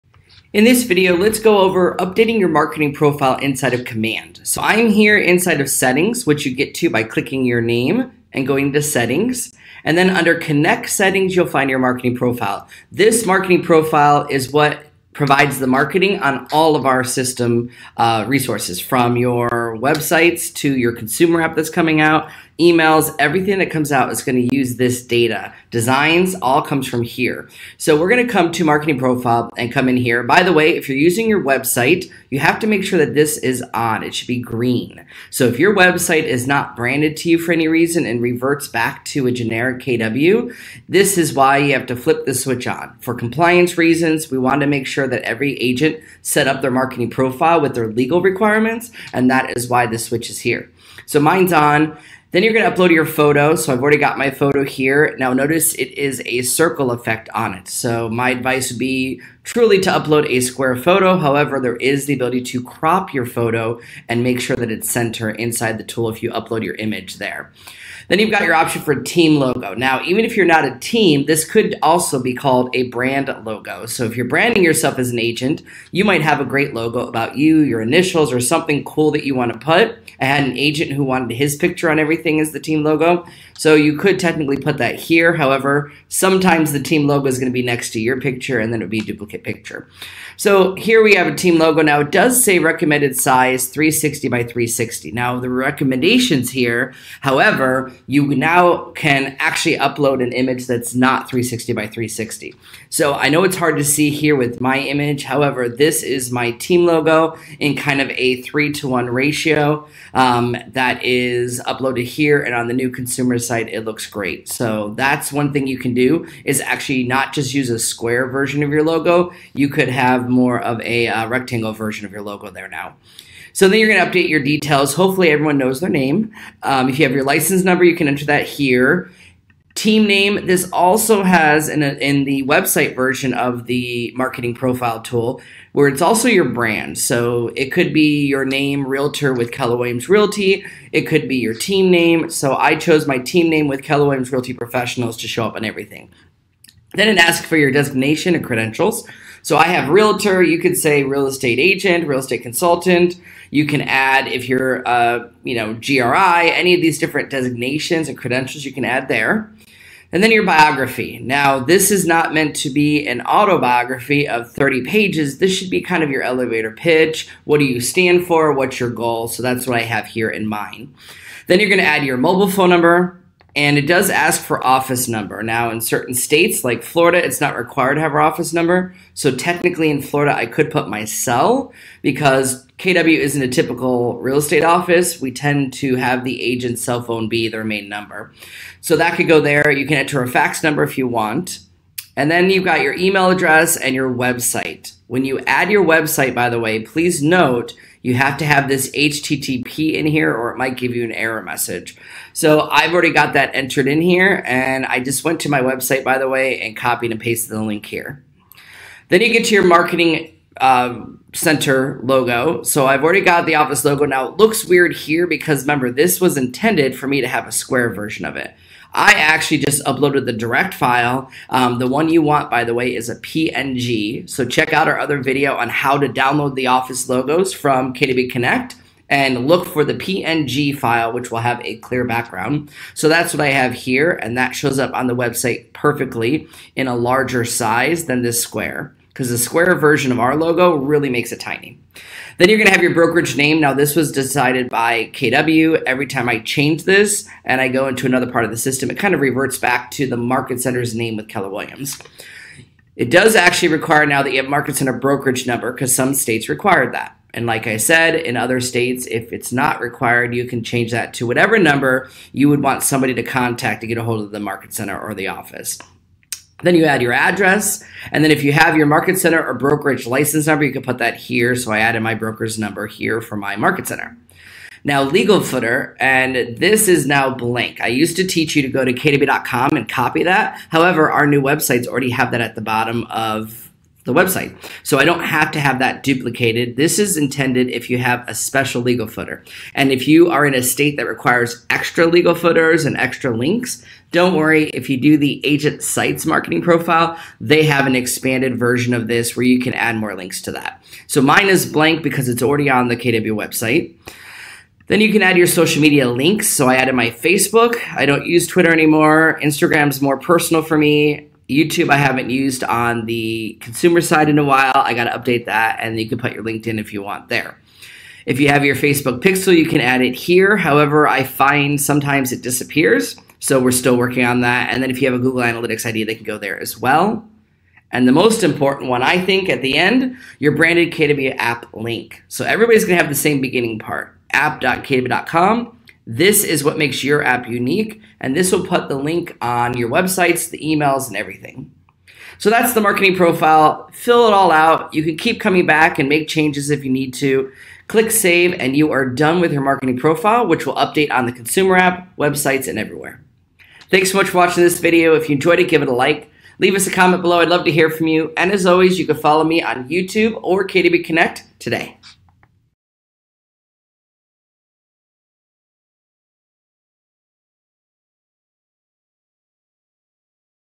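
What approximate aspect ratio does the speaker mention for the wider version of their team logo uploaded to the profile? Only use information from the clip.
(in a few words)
3 to 1.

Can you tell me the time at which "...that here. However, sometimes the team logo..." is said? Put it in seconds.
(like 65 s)
84 s.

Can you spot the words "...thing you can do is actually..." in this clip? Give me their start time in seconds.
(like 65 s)
115 s.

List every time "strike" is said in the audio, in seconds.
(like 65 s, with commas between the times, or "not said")
not said.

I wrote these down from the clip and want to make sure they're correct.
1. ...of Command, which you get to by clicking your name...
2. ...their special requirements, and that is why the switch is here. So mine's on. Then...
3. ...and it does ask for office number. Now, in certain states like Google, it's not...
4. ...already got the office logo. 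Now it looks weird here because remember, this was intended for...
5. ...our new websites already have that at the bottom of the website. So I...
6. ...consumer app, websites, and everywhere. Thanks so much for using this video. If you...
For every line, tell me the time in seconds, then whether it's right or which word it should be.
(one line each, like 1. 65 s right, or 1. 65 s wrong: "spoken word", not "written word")
1. 5 s wrong: "Settings", not "Command"
2. 47 s wrong: "legal", not "special"
3. 173 s wrong: "Florida", not "Google"
4. 213 s right
5. 281 s right
6. 351 s wrong: "watching", not "using".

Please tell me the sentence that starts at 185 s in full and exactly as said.
We tend to have the agent's cell phone be their main number.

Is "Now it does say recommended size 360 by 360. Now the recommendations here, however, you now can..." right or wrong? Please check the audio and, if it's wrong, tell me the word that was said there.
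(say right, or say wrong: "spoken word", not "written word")
right.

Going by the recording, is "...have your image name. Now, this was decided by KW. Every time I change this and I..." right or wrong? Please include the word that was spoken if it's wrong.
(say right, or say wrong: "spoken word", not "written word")
wrong: "brokerage", not "image".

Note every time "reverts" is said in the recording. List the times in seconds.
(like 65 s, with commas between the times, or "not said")
38 s, 249 s.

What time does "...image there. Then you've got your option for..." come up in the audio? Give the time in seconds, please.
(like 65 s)
66 s.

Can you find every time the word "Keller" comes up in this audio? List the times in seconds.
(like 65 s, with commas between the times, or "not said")
139 s, 143 s, 251 s.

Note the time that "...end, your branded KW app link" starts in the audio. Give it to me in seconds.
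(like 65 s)
329 s.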